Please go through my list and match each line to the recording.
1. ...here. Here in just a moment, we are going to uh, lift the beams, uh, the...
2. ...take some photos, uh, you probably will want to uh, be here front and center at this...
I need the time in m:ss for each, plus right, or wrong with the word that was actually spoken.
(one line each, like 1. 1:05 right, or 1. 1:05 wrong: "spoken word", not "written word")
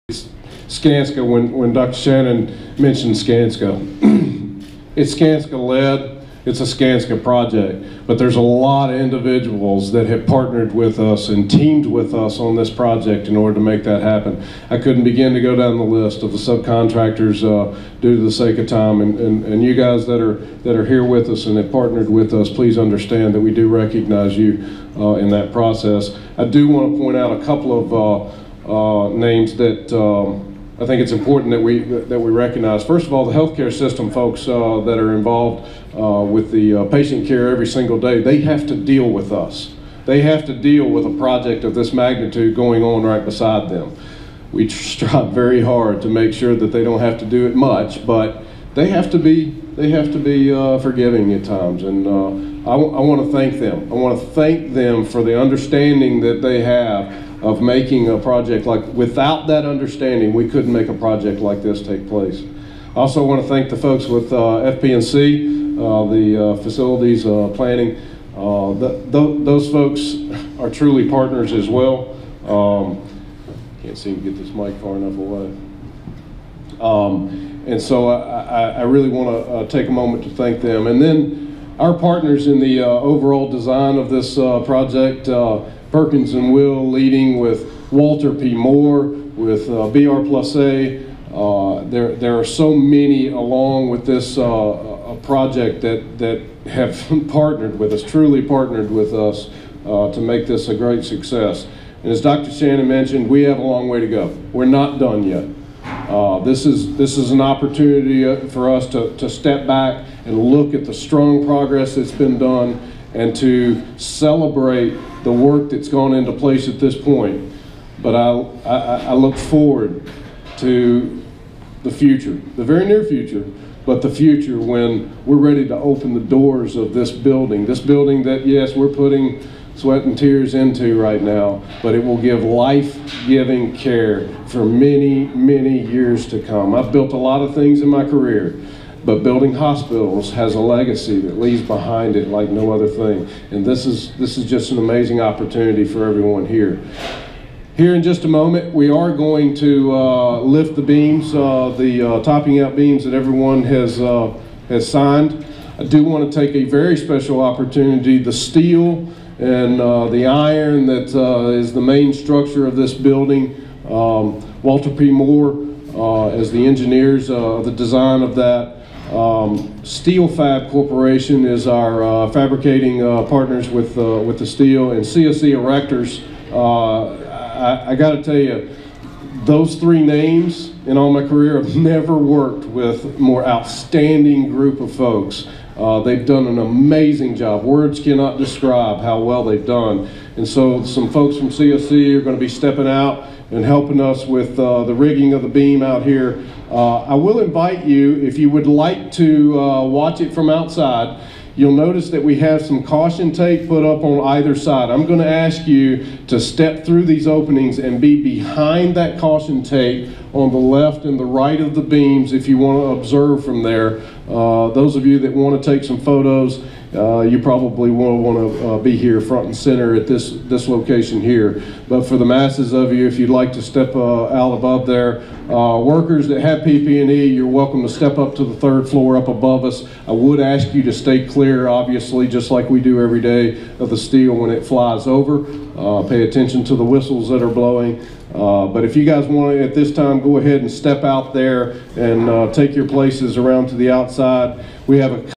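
1. 2:26 right
2. 3:35 right.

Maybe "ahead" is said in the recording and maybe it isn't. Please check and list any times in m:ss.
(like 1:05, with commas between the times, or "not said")
4:00.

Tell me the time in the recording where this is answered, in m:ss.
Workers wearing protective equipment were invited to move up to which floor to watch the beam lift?
3:48.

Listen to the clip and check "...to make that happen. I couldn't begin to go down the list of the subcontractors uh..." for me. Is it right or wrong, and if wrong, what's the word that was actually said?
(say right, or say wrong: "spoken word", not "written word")
right.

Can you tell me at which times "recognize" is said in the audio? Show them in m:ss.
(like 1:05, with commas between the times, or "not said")
0:23, 0:32.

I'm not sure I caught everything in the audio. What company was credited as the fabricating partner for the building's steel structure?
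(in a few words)
SteelFab Corporation.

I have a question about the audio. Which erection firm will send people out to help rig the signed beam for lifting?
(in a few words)
CSC Erectors.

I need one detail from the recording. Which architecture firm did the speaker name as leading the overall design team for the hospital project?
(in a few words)
Perkins and Will.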